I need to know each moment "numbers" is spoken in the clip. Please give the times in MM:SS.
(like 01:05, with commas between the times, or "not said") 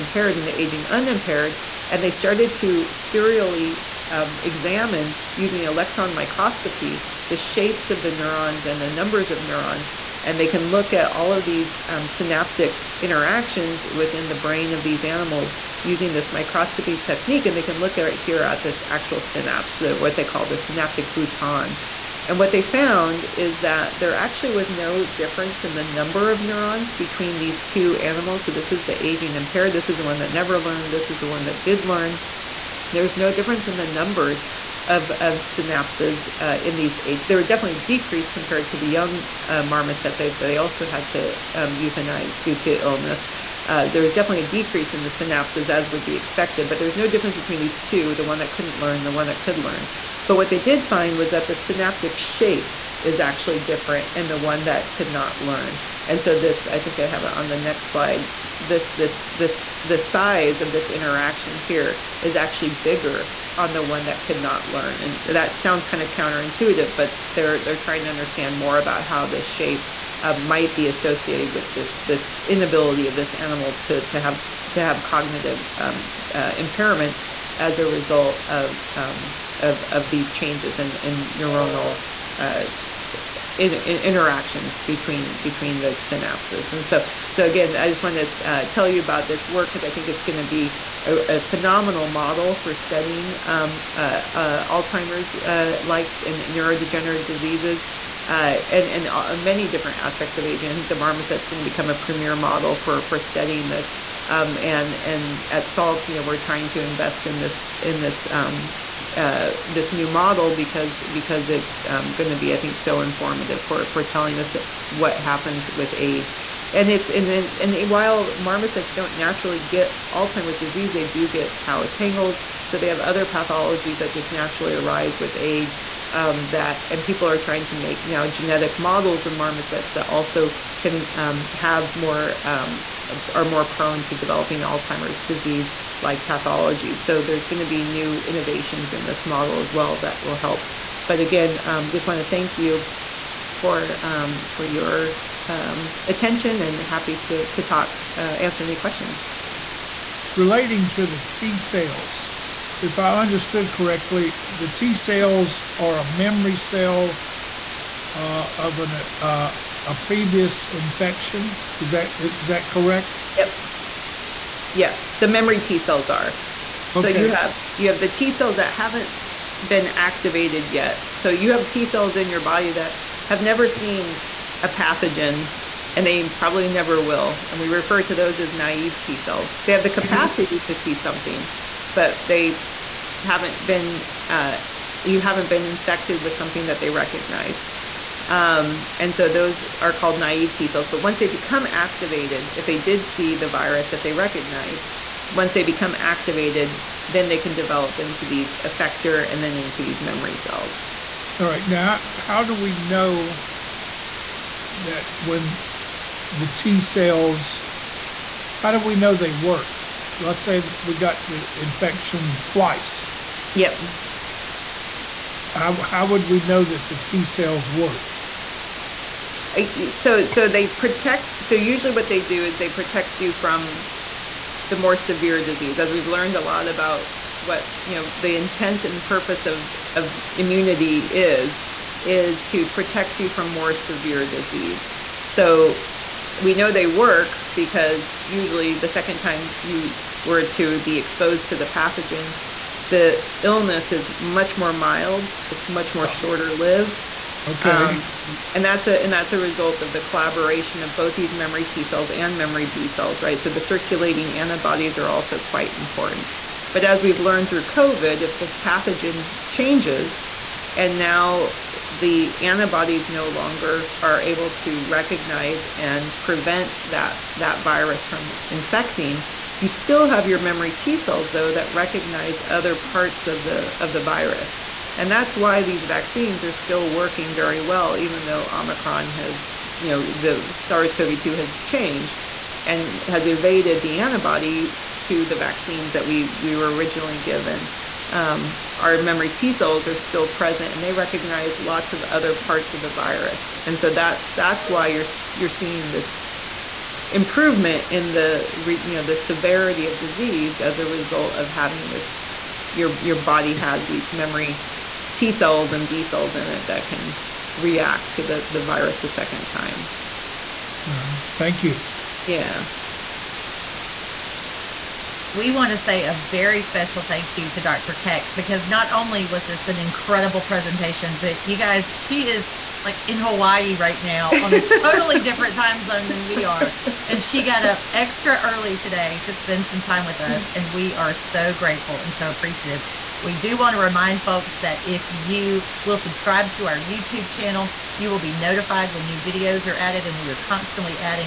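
00:08, 00:25, 00:33.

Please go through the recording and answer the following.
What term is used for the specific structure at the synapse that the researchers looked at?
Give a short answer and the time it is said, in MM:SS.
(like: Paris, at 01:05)
synaptic bouton, at 00:20.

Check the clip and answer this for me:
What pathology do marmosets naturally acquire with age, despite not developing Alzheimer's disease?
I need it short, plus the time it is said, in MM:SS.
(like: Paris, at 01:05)
tau tangles, at 02:01.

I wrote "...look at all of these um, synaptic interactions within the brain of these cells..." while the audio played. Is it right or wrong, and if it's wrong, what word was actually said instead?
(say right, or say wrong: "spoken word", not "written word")
wrong: "animals", not "cells".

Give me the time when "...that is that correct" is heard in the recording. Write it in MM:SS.
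02:41.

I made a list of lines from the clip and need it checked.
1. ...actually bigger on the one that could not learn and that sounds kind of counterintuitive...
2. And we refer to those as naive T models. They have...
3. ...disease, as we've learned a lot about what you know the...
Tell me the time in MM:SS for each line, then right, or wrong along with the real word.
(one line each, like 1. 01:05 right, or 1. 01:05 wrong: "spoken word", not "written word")
1. 01:02 right
2. 02:57 wrong: "cells", not "models"
3. 03:45 right.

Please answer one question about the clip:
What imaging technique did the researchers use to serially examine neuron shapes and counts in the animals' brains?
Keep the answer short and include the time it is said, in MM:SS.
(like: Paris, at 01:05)
electron microscopy, at 00:05.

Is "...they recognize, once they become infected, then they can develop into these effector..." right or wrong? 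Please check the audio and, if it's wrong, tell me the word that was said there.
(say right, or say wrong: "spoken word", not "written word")
wrong: "activated", not "infected".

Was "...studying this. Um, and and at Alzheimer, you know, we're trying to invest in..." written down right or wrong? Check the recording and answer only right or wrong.
wrong.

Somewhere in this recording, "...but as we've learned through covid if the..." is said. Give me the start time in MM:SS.
04:16.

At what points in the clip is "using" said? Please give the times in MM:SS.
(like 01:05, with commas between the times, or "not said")
00:05, 00:15.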